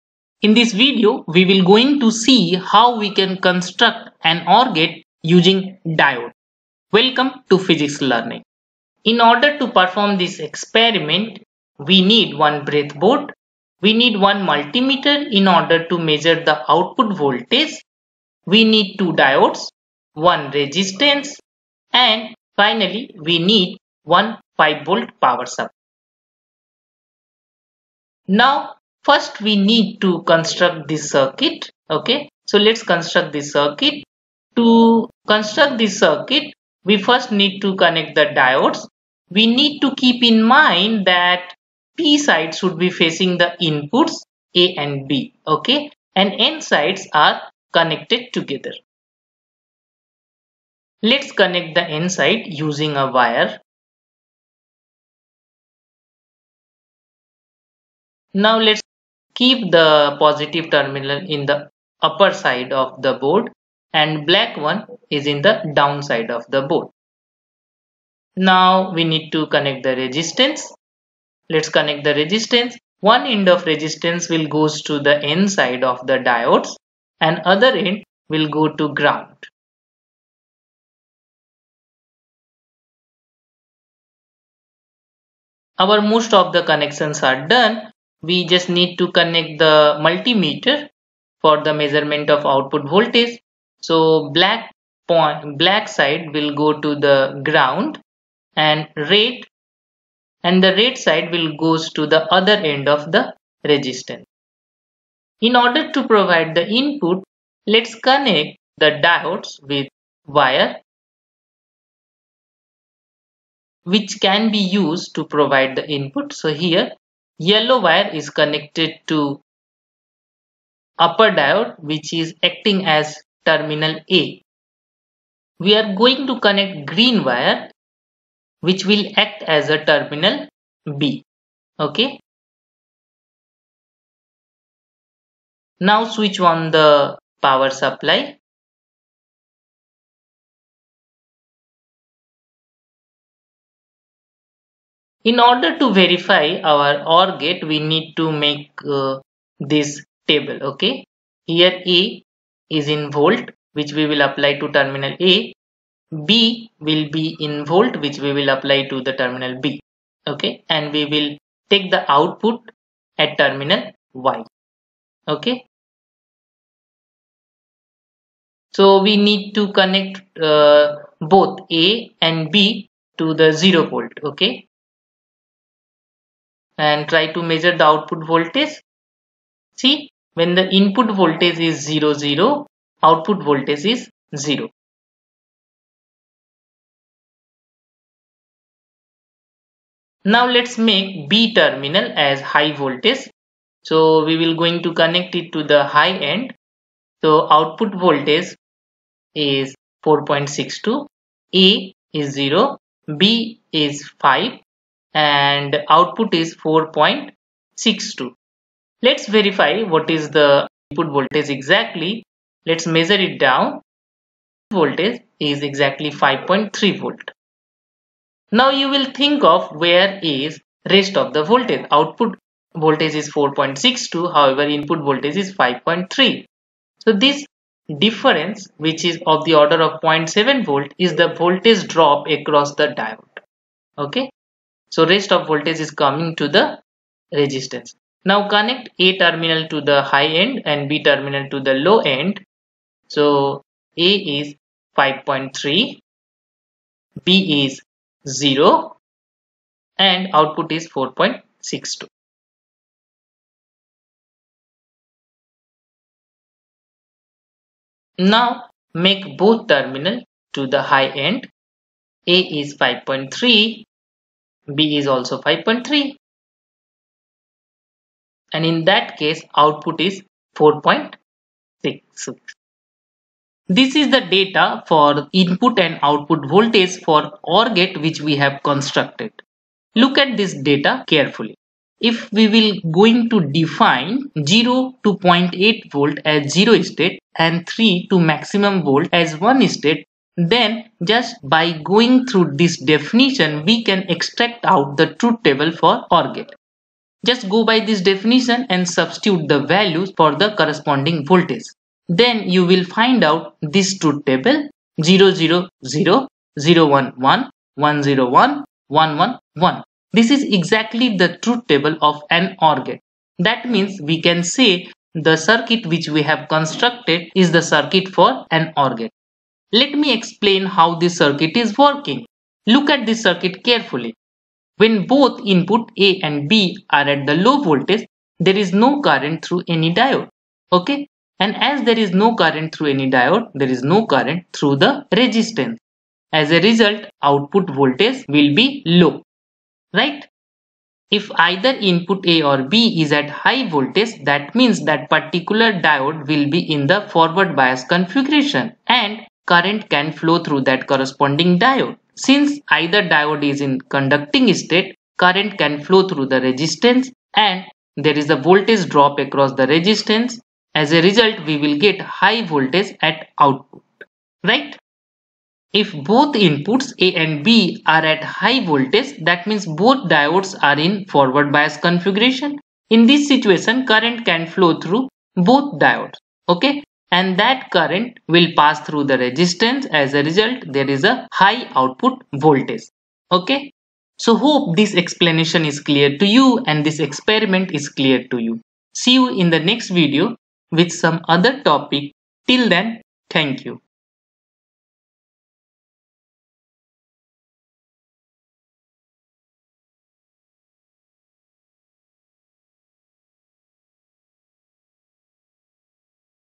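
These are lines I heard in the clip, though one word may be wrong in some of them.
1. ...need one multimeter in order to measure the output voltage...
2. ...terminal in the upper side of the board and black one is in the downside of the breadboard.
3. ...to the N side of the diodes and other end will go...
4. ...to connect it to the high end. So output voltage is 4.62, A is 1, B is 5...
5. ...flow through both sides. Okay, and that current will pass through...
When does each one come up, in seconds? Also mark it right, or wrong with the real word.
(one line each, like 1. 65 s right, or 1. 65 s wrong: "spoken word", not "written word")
1. 13 s right
2. 60 s wrong: "board", not "breadboard"
3. 74 s right
4. 194 s wrong: "0", not "1"
5. 374 s wrong: "diodes", not "sides".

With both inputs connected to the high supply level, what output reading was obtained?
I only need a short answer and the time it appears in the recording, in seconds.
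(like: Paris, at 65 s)
4.66, at 270 s.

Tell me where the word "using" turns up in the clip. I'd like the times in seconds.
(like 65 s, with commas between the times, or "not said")
5 s, 52 s.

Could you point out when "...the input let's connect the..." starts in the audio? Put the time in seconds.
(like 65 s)
106 s.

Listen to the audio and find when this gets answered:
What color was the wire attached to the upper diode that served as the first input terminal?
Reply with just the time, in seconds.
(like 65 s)
117 s.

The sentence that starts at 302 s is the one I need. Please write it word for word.
Then you will find out this truth table 000, 000 011, 101, 111.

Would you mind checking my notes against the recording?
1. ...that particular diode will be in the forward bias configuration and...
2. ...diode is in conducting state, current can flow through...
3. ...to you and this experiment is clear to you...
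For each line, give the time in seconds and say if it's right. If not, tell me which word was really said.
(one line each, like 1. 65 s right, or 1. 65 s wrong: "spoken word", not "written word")
1. 344 s right
2. 353 s right
3. 386 s right.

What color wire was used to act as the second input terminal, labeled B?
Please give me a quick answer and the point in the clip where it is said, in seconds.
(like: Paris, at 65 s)
green, at 126 s.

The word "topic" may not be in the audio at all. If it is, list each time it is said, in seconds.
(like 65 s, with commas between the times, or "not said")
391 s.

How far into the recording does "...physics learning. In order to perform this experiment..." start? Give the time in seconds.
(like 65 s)
7 s.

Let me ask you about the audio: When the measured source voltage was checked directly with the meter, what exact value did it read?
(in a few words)
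5.3 volt.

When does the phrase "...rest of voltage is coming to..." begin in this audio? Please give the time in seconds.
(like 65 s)
235 s.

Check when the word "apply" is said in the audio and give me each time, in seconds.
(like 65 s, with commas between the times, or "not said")
154 s, 158 s.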